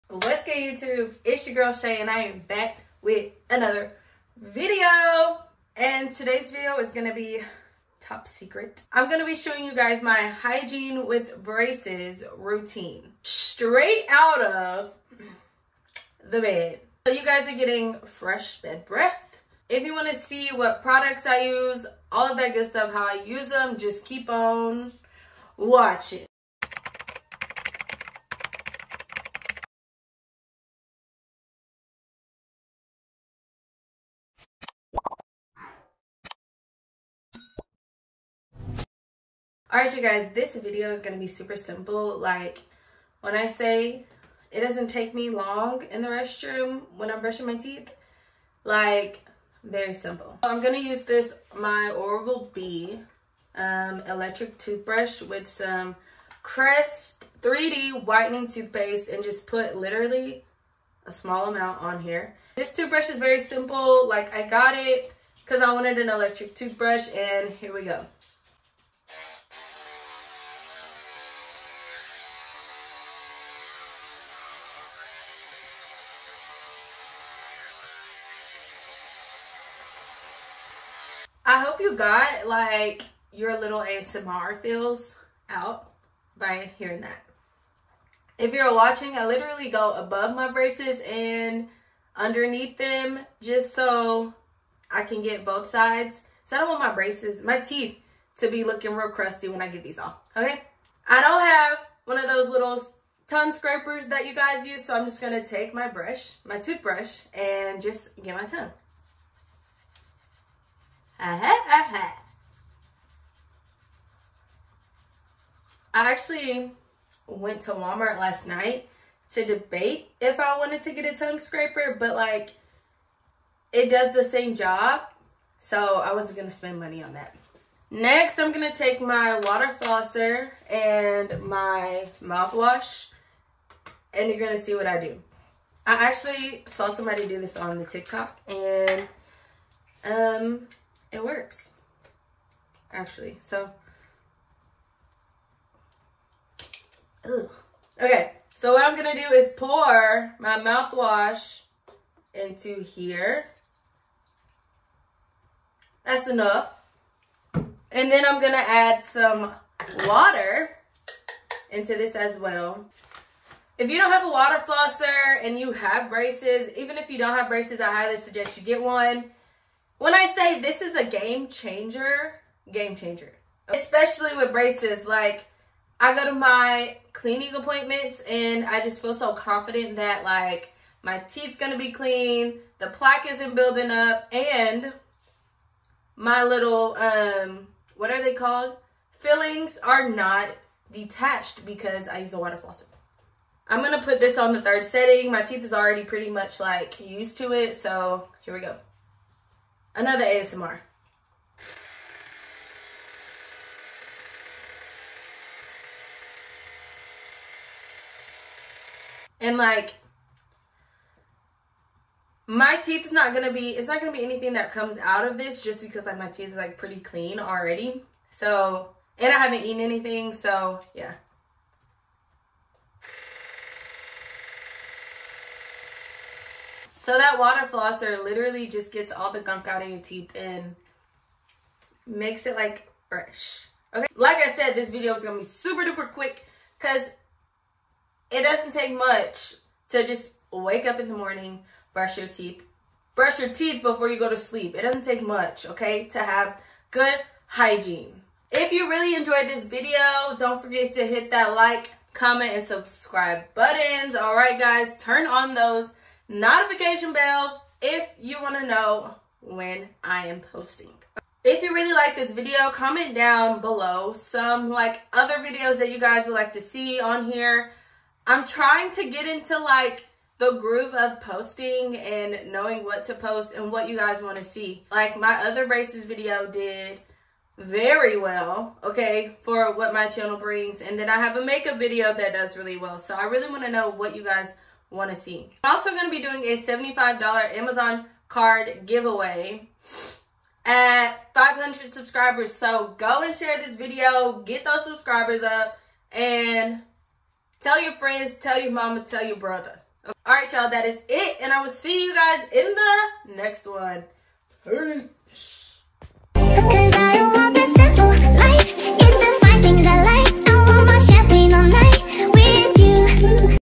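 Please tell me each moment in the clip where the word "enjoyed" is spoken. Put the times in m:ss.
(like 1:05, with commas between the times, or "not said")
4:09.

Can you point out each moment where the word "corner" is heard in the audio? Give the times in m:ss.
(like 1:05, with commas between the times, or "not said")
not said.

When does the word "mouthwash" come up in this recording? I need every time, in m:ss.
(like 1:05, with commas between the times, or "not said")
2:12, 2:30.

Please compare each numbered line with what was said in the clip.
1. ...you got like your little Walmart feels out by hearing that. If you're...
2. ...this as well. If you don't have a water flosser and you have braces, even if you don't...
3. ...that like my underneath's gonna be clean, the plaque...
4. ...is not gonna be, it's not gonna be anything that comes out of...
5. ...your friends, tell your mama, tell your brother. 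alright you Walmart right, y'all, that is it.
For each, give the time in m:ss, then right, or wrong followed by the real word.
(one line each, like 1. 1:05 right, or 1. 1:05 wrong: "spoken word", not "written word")
1. 1:21 wrong: "ASMR", not "Walmart"
2. 2:41 right
3. 2:59 wrong: "teeth", not "underneath"
4. 3:33 right
5. 4:57 wrong: "All", not "Walmart".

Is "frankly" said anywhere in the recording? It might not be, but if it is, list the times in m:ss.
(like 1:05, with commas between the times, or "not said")
not said.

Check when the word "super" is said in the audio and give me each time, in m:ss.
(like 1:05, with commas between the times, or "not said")
0:41, 3:55.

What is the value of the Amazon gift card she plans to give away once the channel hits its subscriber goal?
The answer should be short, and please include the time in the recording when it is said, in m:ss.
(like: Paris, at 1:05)
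$75, at 4:46.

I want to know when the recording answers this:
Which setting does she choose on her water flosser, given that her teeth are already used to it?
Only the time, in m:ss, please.
3:14.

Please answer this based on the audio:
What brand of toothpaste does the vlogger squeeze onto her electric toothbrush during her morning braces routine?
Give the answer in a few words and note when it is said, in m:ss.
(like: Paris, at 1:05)
Crest 3D Whitening, at 0:56.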